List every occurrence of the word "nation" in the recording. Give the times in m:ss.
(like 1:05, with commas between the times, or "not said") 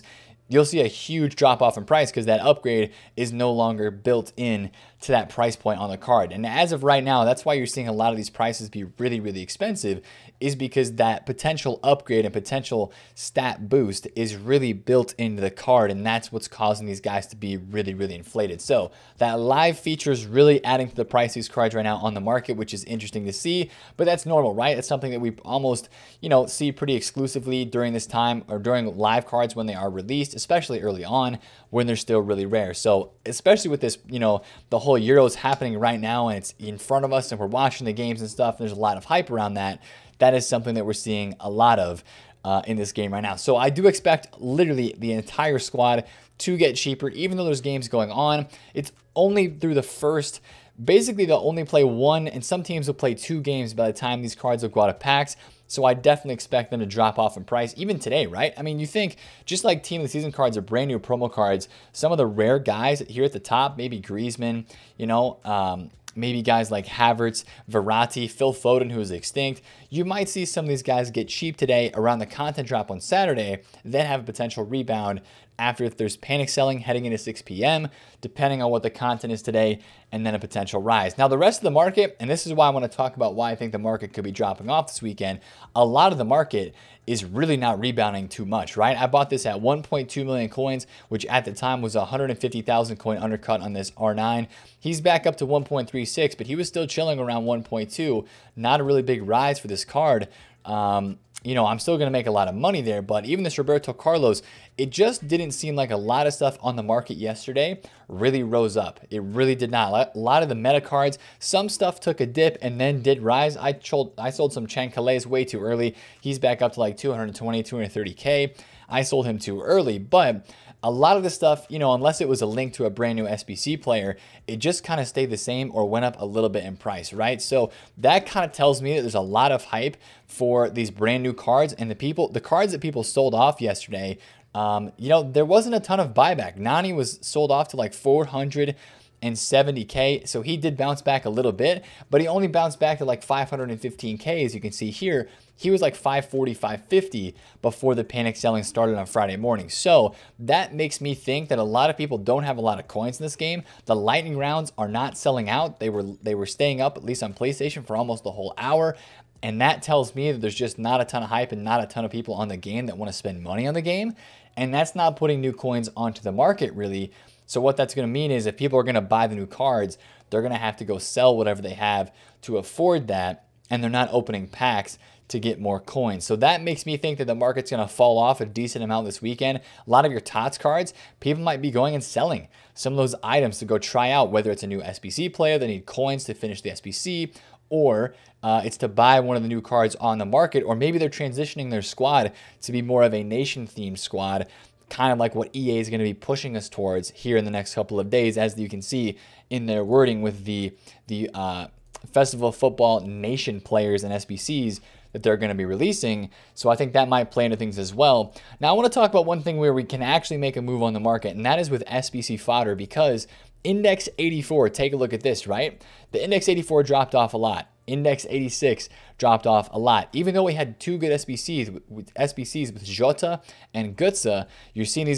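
3:13, 3:23.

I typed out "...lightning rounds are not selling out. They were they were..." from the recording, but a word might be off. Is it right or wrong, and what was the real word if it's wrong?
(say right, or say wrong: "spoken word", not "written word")
right.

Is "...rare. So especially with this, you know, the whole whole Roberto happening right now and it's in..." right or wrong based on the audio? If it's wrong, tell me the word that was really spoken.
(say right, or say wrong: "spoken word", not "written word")
wrong: "Euros", not "Roberto".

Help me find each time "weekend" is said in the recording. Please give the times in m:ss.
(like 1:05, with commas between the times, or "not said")
1:25, 2:59.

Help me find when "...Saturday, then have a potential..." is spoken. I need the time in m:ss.
1:12.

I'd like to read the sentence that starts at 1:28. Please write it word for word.
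I bought this at 1.2 million coins, which at the time was 150,000 coin undercut on this R9.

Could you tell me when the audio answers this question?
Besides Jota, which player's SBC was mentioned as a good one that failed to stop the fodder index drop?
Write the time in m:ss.
3:43.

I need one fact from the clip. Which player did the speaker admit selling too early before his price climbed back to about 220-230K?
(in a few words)
Cancelo.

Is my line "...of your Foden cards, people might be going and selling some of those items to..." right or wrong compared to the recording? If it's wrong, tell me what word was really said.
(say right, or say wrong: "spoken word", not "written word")
wrong: "TOTS", not "Foden".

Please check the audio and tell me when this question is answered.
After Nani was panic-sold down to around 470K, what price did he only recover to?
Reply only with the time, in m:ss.
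2:23.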